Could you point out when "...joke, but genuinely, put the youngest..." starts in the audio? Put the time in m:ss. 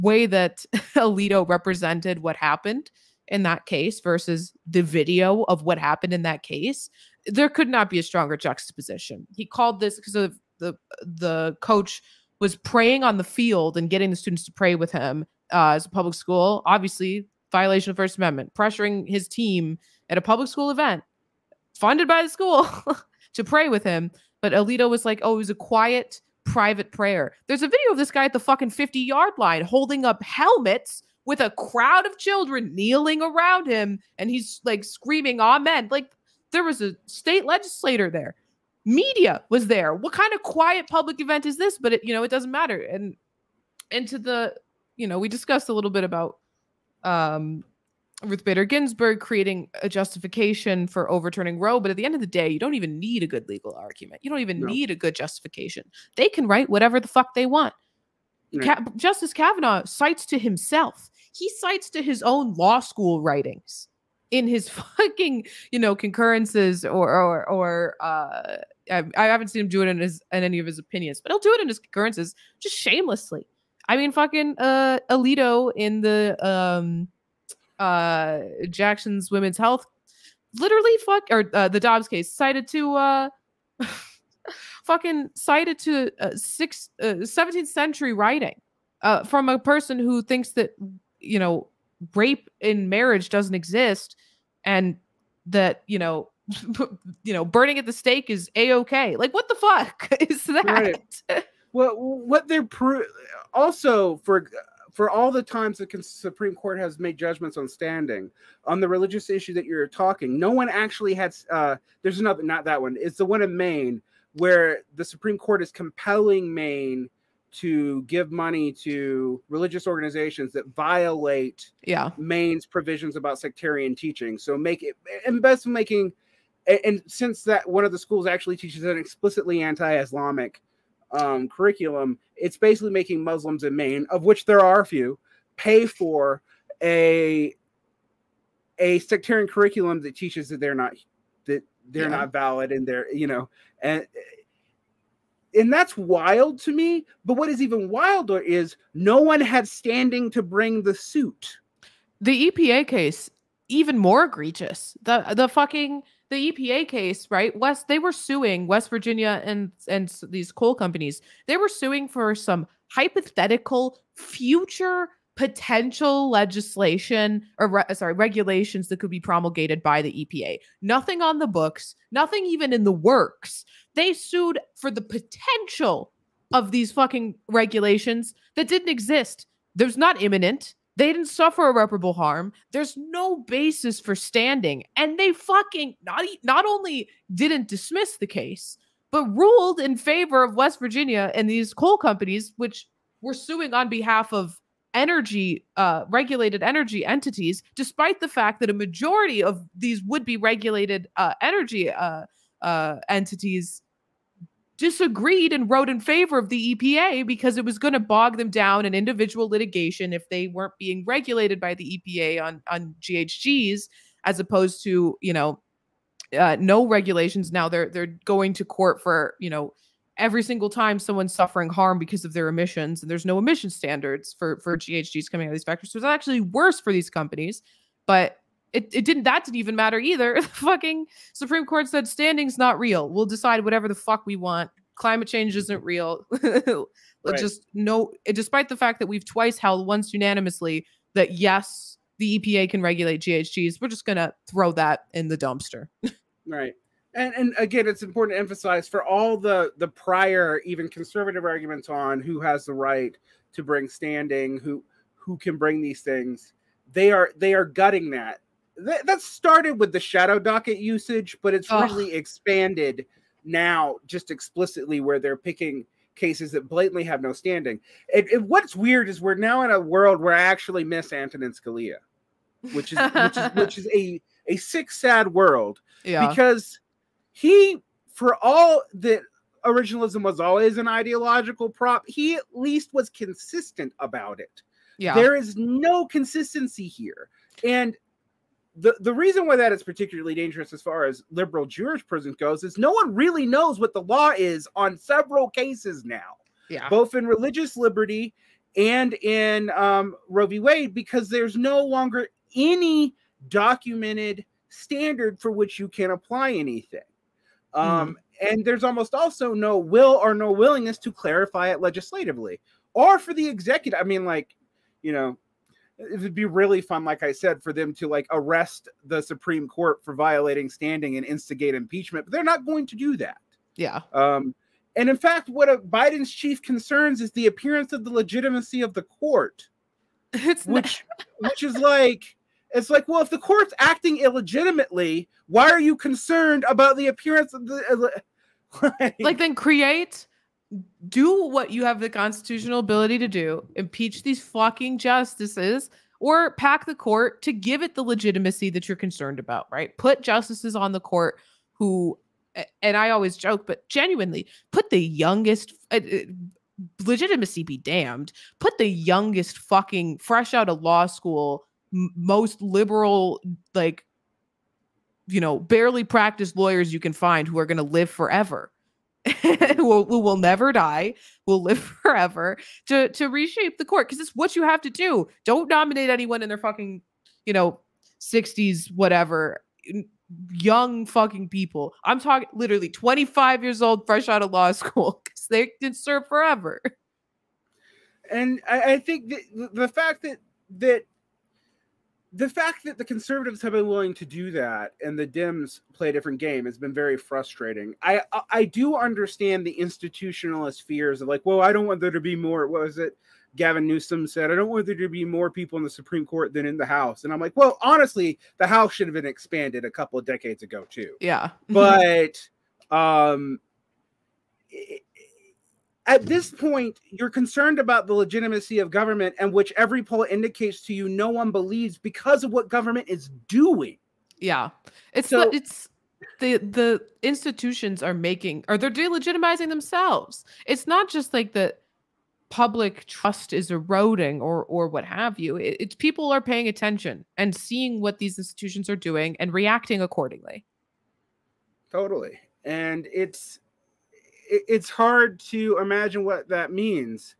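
5:53.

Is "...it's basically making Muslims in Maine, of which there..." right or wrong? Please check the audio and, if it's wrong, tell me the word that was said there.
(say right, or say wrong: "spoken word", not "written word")
right.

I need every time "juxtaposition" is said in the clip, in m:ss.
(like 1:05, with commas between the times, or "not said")
0:08.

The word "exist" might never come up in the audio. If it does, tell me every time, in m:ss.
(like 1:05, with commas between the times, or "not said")
1:33, 2:58.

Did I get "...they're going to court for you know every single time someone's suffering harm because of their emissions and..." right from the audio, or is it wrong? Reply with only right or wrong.
right.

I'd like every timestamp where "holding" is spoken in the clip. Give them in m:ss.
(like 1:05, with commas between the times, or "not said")
0:29.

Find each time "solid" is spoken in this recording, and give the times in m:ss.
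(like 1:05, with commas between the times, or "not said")
not said.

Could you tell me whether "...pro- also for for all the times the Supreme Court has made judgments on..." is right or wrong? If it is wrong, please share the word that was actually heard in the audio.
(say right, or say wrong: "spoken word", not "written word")
right.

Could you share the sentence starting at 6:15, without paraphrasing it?
Don't nominate anyone in their fucking, you know, 60s, whatever, young fucking people.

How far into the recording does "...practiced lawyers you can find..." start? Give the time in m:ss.
6:06.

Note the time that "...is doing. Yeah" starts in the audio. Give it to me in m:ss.
7:03.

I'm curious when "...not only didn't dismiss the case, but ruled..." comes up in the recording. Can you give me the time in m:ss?
3:06.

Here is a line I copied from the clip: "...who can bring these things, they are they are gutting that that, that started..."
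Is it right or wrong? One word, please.
right.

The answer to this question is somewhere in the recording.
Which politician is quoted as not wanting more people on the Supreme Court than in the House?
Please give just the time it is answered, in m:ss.
6:43.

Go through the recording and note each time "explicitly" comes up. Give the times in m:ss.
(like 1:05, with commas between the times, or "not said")
2:08, 4:24.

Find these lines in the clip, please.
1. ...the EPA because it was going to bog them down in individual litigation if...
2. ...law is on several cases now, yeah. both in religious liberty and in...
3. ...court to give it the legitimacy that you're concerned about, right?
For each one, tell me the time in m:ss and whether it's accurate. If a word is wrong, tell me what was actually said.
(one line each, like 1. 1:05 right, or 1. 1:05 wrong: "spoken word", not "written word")
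1. 3:26 right
2. 4:54 right
3. 5:46 right.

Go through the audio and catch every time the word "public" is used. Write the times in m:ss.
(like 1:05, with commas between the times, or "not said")
0:15, 0:20, 0:40, 7:12.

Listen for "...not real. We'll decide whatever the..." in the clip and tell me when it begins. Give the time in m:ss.
3:52.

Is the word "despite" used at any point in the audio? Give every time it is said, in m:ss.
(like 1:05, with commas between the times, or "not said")
3:17, 3:58.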